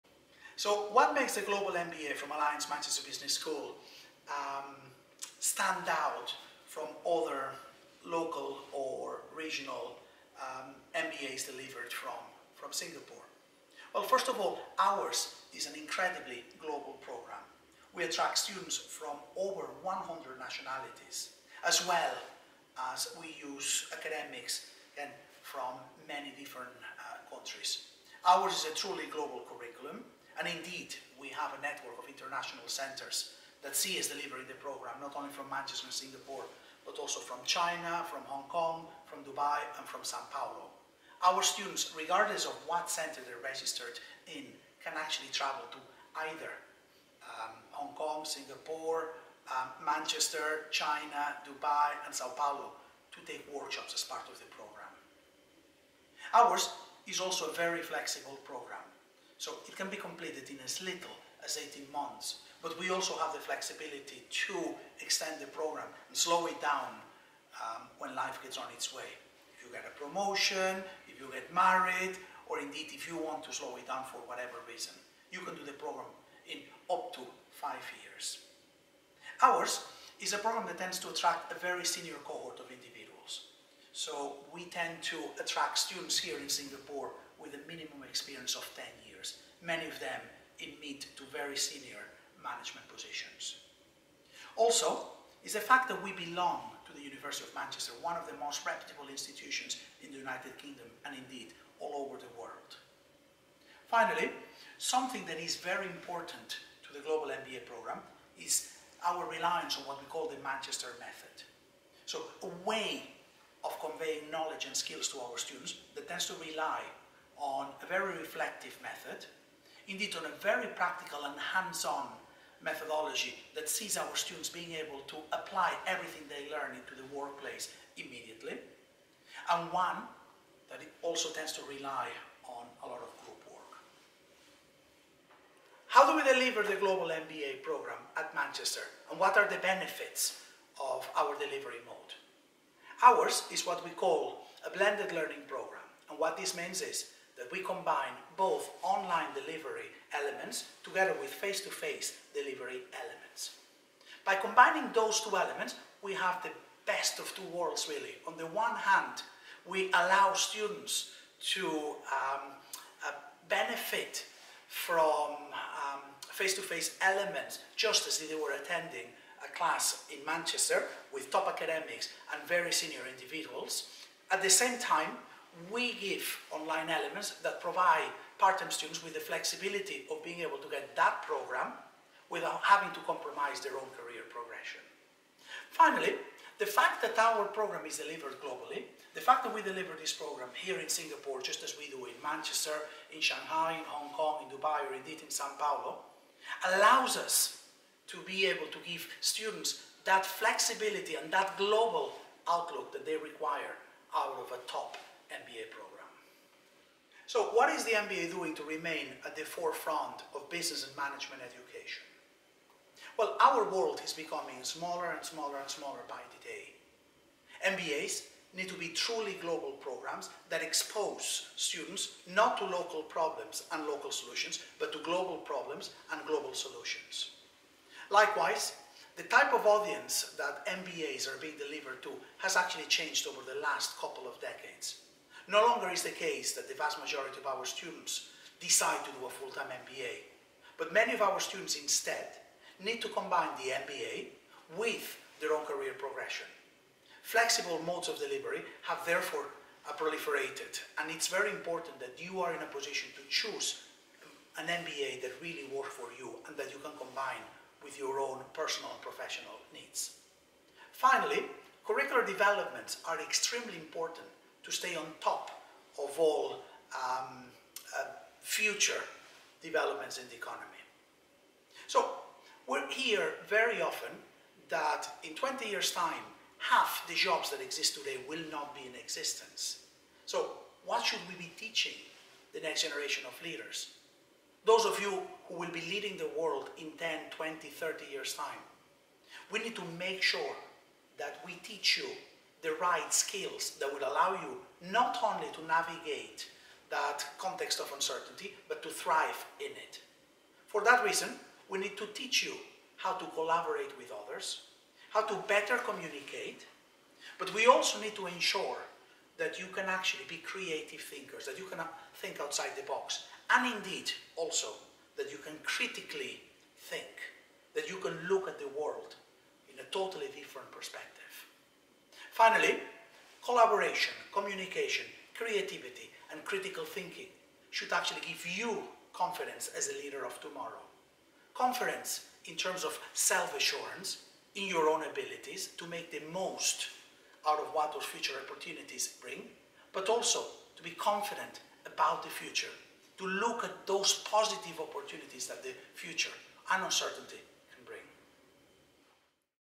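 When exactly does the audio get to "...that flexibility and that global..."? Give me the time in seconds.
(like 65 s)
200 s.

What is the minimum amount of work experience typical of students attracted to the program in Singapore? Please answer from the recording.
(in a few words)
10 years.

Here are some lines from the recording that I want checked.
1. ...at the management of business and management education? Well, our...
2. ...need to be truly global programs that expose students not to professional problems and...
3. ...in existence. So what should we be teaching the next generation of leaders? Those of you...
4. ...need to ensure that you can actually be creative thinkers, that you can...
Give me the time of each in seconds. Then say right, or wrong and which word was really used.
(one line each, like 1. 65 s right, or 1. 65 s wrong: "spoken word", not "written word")
1. 209 s wrong: "forefront", not "management"
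2. 218 s wrong: "local", not "professional"
3. 278 s right
4. 307 s right.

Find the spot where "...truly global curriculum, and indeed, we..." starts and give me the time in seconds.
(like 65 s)
28 s.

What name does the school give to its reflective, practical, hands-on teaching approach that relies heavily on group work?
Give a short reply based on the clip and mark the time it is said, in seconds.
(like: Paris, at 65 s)
Manchester method, at 110 s.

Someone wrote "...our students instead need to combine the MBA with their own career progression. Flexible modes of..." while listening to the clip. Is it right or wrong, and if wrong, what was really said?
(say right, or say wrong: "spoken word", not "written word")
right.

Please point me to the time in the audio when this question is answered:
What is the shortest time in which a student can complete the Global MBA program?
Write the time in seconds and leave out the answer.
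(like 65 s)
61 s.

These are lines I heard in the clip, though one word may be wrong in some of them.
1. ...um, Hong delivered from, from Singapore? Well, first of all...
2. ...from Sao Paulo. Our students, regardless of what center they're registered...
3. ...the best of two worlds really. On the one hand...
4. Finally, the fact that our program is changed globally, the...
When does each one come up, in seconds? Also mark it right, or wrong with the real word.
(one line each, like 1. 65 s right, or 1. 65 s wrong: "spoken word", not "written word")
1. 10 s wrong: "MBAs", not "Hong"
2. 39 s right
3. 156 s right
4. 185 s wrong: "delivered", not "changed".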